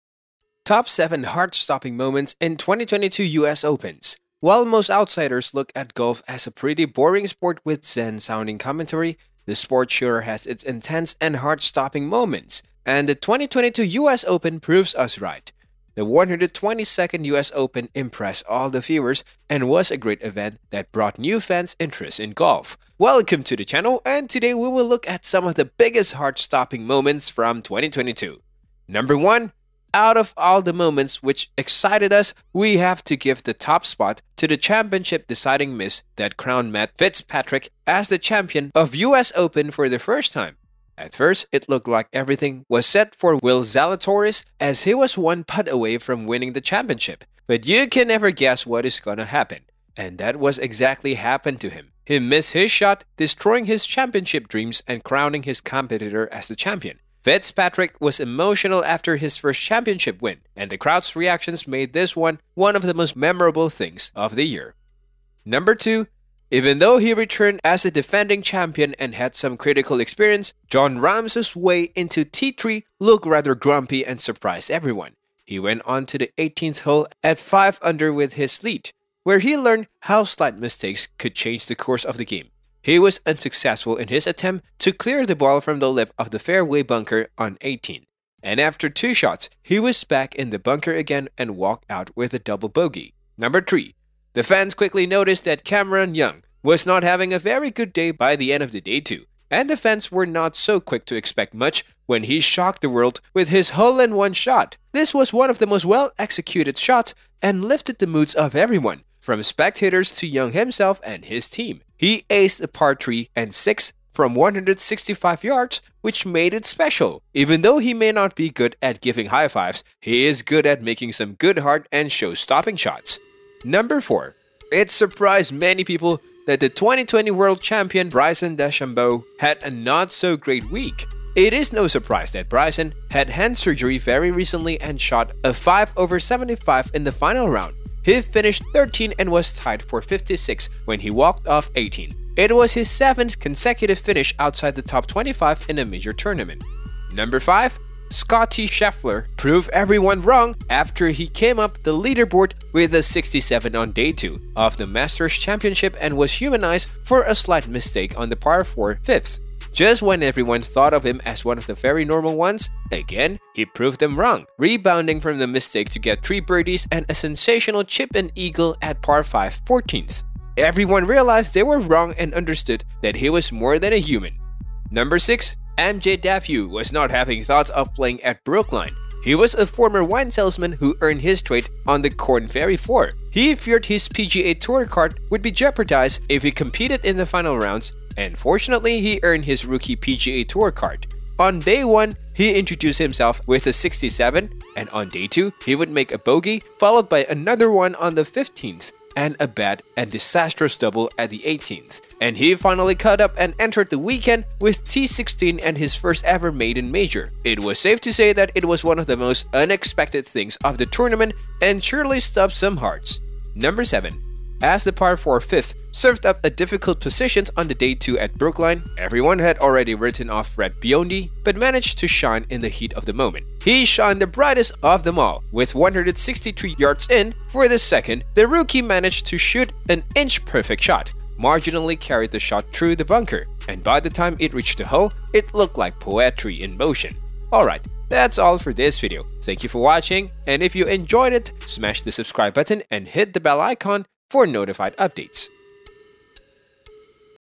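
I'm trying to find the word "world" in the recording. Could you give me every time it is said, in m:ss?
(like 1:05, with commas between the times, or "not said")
1:42, 2:07.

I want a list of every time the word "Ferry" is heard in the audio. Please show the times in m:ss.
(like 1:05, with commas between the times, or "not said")
3:02.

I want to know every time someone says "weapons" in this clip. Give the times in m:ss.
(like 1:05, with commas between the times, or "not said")
not said.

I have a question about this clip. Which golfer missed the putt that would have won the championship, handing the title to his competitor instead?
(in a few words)
Will Zalatoris.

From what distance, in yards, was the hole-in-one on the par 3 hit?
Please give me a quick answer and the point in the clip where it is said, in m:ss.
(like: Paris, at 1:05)
165, at 1:54.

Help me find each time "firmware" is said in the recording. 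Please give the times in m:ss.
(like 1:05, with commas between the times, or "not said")
not said.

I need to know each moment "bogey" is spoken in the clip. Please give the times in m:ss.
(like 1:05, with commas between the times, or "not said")
1:32, 3:16.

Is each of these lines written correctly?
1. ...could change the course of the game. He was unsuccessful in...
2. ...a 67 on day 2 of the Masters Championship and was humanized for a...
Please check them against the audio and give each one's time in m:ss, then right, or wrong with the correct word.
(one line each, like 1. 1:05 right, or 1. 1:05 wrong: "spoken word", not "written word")
1. 1:21 right
2. 2:32 right.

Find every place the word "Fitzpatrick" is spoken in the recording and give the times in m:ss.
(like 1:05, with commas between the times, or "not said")
0:36, 0:57.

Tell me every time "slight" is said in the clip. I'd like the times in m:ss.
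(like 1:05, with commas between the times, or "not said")
1:20, 2:37.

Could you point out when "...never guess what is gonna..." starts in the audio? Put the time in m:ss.
0:48.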